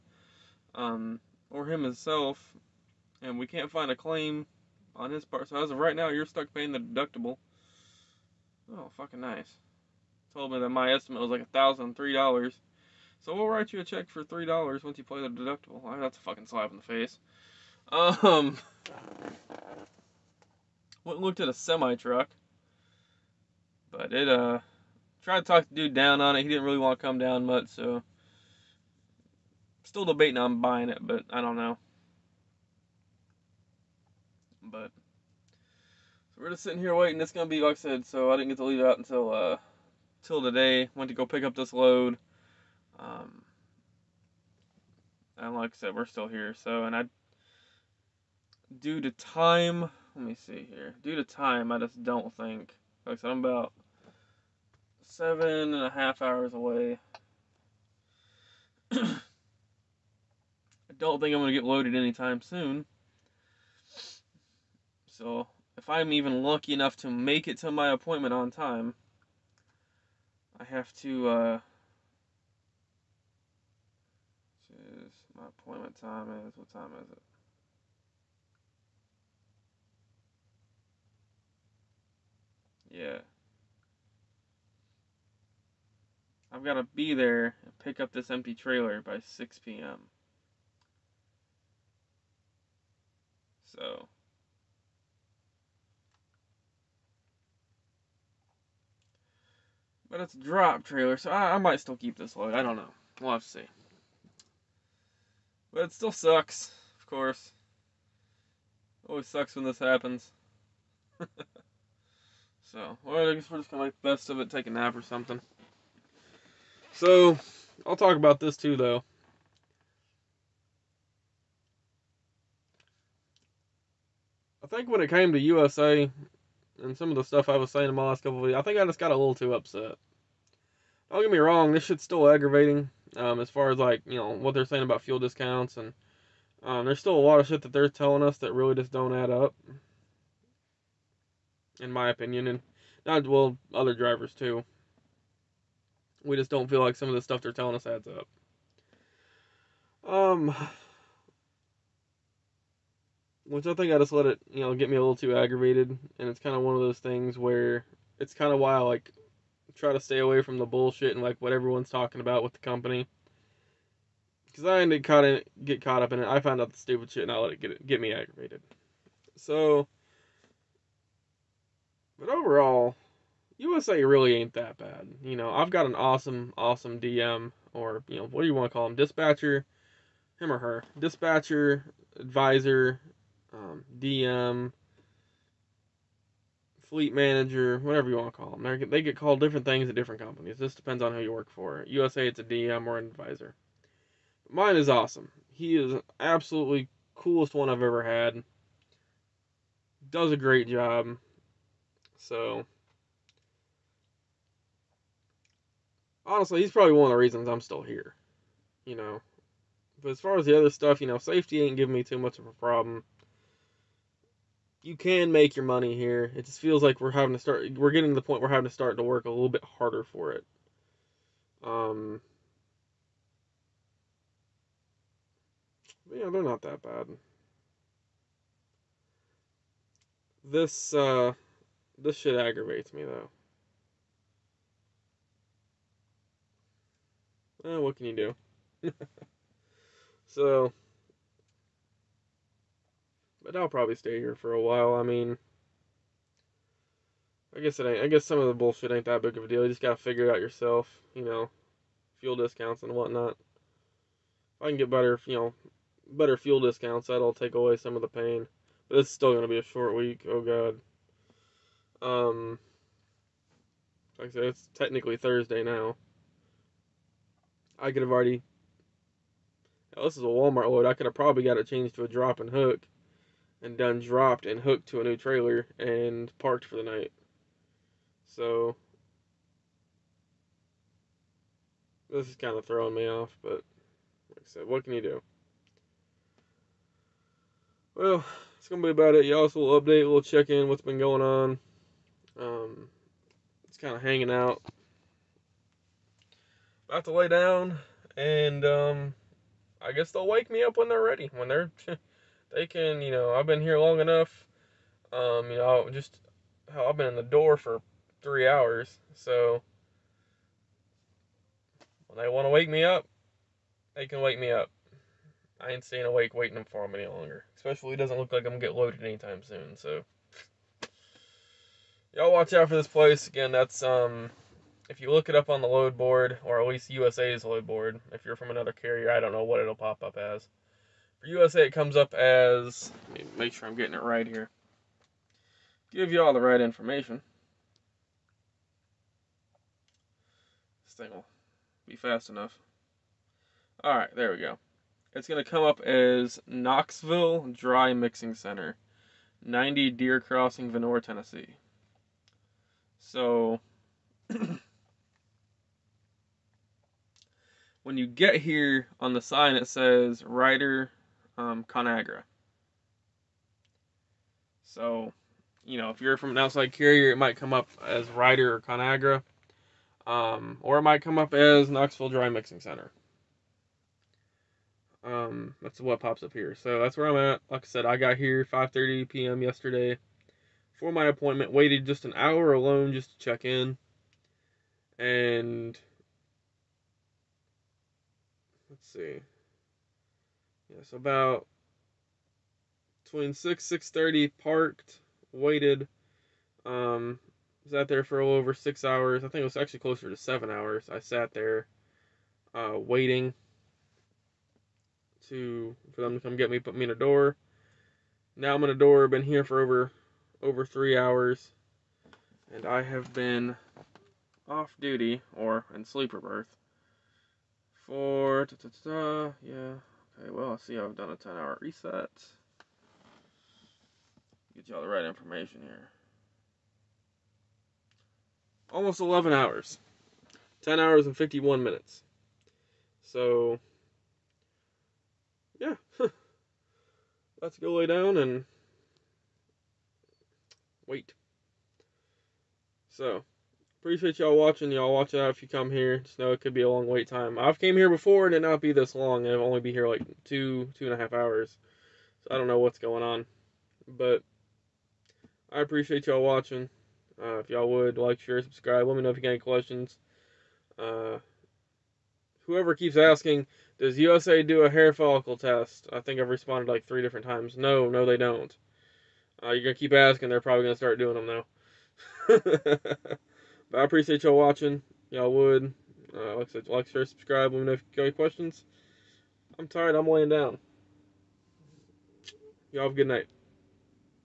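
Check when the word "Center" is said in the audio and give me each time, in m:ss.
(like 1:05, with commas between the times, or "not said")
5:48, 6:12.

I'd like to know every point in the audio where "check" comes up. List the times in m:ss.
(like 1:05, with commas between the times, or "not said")
0:13, 4:50, 6:23.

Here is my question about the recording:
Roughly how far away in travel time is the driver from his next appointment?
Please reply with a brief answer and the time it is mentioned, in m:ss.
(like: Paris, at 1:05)
7.5 hours, at 0:55.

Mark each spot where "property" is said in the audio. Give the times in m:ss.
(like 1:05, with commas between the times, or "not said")
not said.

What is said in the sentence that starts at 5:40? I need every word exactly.
This thing will be fast enough.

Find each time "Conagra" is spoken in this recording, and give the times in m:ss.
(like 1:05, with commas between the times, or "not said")
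6:01, 6:08.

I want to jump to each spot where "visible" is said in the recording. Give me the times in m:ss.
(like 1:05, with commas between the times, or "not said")
not said.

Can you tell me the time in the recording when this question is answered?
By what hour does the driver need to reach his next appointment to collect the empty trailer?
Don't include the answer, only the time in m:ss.
1:29.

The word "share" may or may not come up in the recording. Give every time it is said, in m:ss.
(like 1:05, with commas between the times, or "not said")
7:38, 7:56.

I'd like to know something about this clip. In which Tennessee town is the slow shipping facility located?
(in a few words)
Vonore.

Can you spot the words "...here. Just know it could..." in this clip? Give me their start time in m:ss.
7:25.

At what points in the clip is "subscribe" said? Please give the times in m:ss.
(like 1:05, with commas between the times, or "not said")
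7:38, 7:57.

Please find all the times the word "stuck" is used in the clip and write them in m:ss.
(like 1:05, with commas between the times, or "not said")
0:06.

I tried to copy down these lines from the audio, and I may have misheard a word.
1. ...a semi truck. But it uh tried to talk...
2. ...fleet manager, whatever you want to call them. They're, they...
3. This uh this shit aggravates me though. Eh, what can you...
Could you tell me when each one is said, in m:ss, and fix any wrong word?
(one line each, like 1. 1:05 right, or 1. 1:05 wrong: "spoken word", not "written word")
1. 0:21 right
2. 3:06 right
3. 3:50 right.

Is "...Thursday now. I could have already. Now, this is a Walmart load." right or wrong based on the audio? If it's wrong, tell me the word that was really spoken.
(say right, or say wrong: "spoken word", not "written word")
right.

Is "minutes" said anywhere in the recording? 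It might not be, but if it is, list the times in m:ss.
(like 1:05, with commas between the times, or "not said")
7:11.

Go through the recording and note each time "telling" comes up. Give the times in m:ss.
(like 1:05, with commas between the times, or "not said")
2:17, 2:27.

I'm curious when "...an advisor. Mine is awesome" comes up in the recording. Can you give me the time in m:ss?
3:12.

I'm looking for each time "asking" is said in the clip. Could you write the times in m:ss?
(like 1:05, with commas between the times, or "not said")
7:42, 7:49.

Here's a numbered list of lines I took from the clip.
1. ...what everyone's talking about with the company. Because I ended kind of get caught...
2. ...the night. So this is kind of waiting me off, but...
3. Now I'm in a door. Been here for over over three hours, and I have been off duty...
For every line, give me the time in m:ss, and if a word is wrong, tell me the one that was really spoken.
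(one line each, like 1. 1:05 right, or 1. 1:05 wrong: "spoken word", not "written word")
1. 2:41 right
2. 4:36 wrong: "throwing", not "waiting"
3. 6:48 right.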